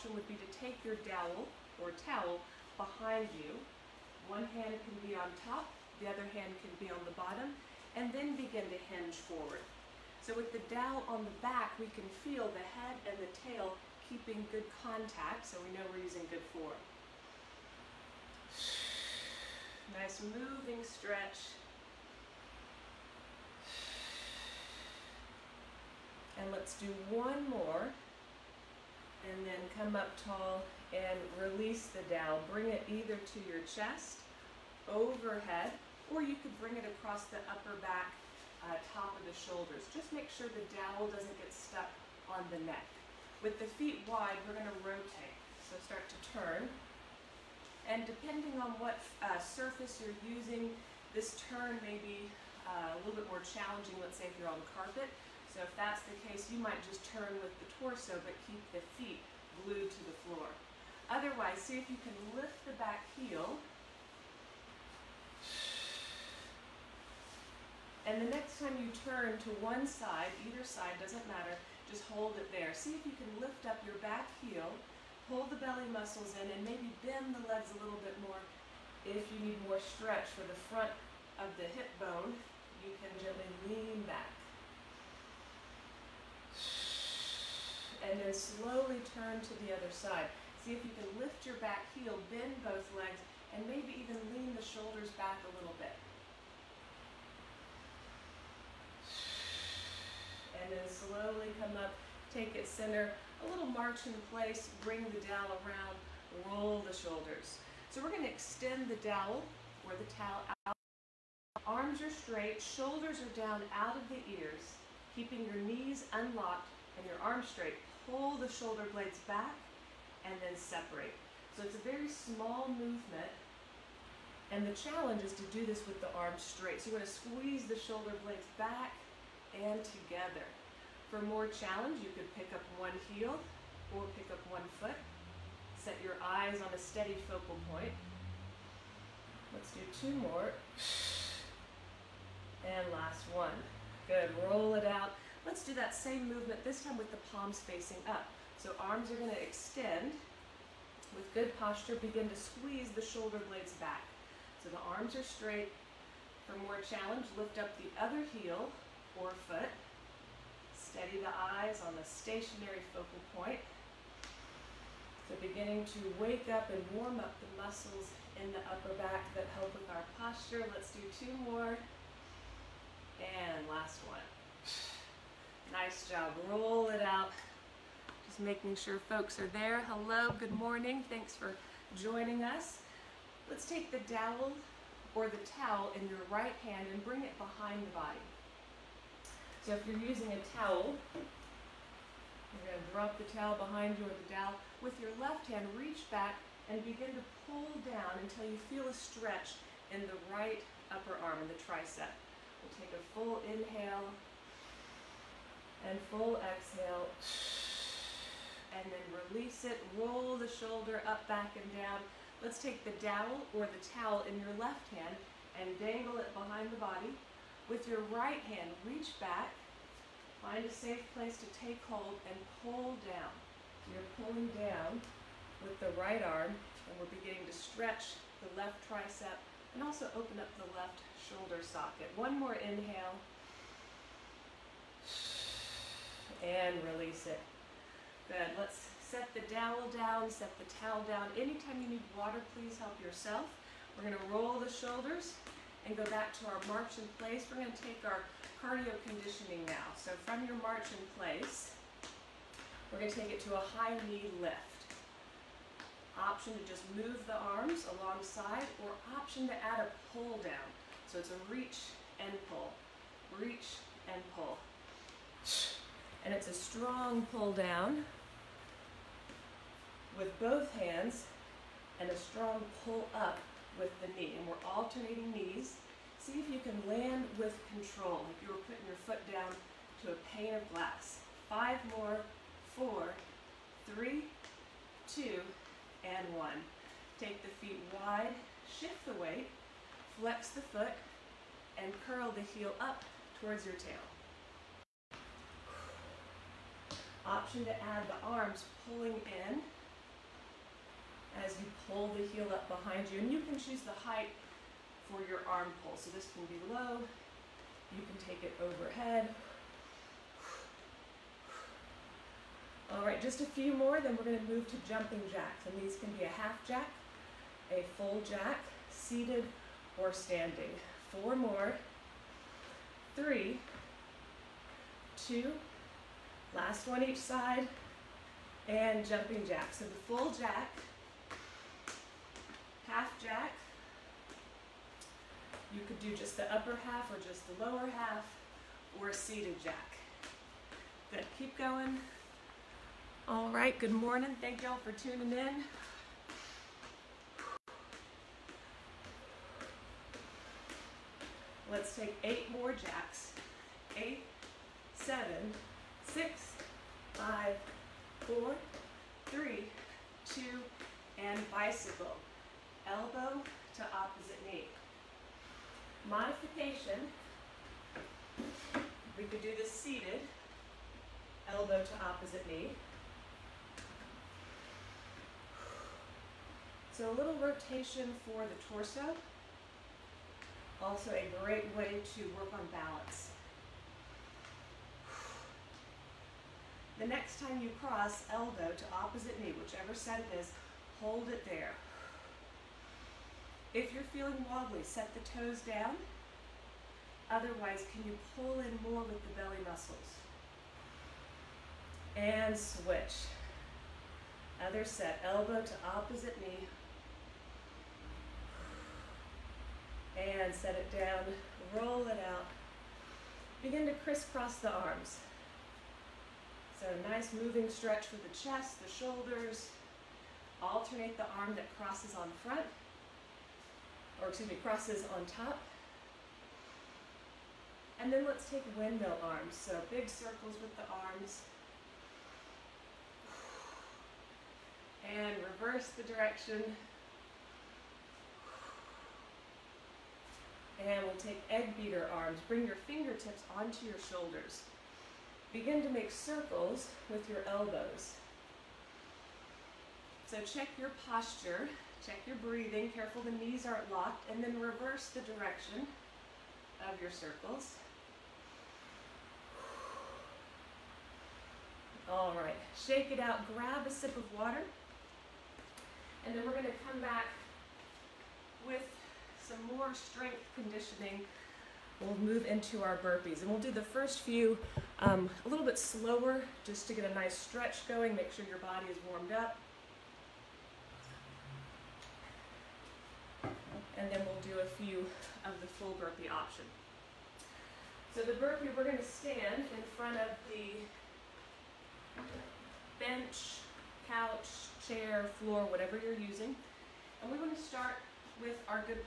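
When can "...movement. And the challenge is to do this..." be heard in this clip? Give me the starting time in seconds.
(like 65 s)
122 s.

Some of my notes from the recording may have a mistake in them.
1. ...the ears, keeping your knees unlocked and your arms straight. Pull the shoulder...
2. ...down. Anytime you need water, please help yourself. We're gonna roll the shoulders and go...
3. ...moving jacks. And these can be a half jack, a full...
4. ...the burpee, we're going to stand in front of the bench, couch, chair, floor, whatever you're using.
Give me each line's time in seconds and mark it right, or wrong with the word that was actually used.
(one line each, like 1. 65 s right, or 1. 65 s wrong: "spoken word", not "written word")
1. 114 s right
2. 241 s right
3. 314 s wrong: "jumping", not "moving"
4. 488 s right.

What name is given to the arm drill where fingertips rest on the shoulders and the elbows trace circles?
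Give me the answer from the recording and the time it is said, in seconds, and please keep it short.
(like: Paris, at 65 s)
Egg beater arms, at 441 s.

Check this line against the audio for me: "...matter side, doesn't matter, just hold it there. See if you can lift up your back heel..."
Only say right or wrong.
wrong.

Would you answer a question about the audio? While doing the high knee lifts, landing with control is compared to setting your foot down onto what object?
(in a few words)
A pane of glass.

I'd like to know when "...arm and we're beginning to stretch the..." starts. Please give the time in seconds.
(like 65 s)
226 s.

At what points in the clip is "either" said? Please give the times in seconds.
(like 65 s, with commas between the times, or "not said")
32 s, 70 s.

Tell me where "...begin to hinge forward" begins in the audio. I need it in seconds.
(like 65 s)
8 s.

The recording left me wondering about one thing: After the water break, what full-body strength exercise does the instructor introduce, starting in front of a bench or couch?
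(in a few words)
Burpees.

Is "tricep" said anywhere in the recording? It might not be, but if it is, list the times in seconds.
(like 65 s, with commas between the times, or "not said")
201 s, 228 s.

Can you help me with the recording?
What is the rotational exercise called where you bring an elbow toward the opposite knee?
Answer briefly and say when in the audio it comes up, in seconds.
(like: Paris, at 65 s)
Bicycle, at 361 s.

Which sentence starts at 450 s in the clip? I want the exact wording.
So check your posture Check your breathing, careful the knees aren't locked, and then reverse the direction of your circles.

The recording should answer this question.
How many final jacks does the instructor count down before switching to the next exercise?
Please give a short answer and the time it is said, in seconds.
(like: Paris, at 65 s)
8, at 352 s.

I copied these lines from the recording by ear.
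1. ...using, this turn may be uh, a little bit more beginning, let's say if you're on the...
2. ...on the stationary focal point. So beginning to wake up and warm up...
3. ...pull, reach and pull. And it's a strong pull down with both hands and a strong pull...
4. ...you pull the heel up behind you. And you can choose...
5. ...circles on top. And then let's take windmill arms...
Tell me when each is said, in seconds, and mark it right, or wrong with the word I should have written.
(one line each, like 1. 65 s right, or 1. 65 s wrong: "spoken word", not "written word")
1. 50 s wrong: "challenging", not "beginning"
2. 161 s right
3. 262 s right
4. 301 s right
5. 424 s wrong: "crosses", not "circles".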